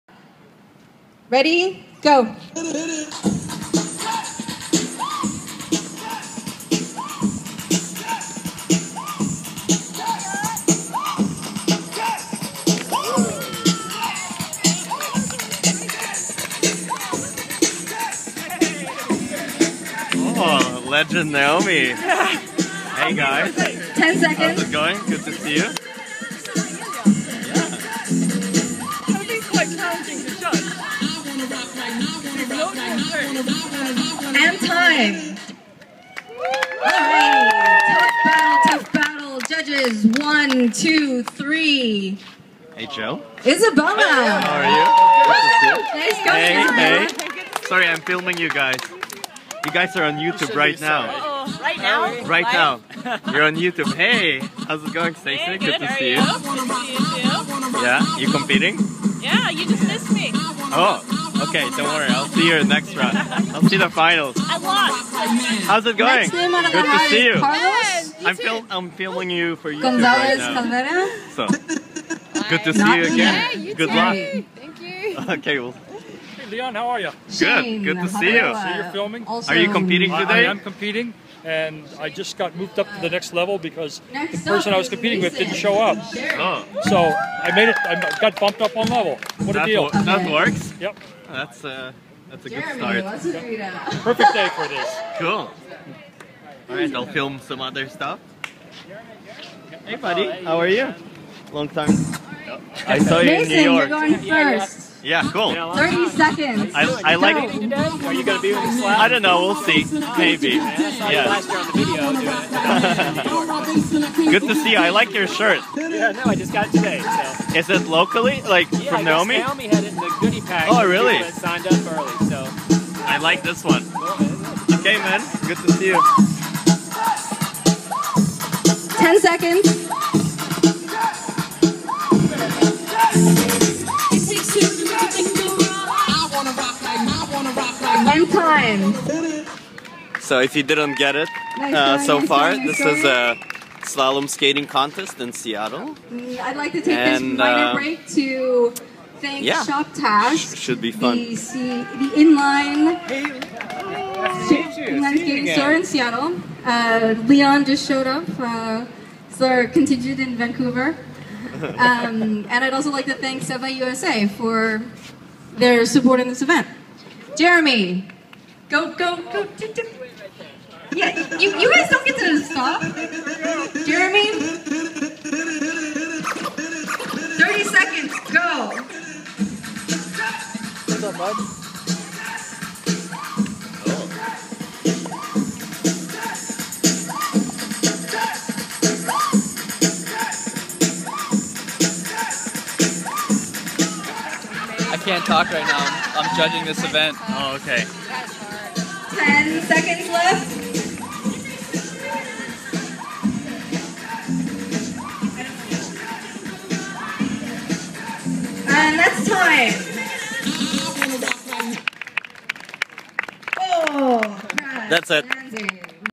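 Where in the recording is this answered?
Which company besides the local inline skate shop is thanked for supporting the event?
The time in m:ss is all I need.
2:43.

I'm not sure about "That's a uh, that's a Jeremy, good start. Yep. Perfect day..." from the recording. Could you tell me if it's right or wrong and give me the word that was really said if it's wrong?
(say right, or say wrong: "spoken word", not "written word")
right.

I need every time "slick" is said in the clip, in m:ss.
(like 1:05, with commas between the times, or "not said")
not said.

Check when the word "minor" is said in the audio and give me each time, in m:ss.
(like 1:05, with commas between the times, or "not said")
2:27.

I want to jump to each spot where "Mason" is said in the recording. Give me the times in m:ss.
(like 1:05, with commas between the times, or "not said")
1:43.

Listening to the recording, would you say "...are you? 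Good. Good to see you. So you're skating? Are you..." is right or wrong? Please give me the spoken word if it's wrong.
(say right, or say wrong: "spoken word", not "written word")
wrong: "filming", not "skating".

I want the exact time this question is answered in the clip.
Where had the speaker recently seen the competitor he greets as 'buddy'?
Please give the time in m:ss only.
1:43.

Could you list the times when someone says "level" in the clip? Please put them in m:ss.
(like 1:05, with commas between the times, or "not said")
1:23, 1:28.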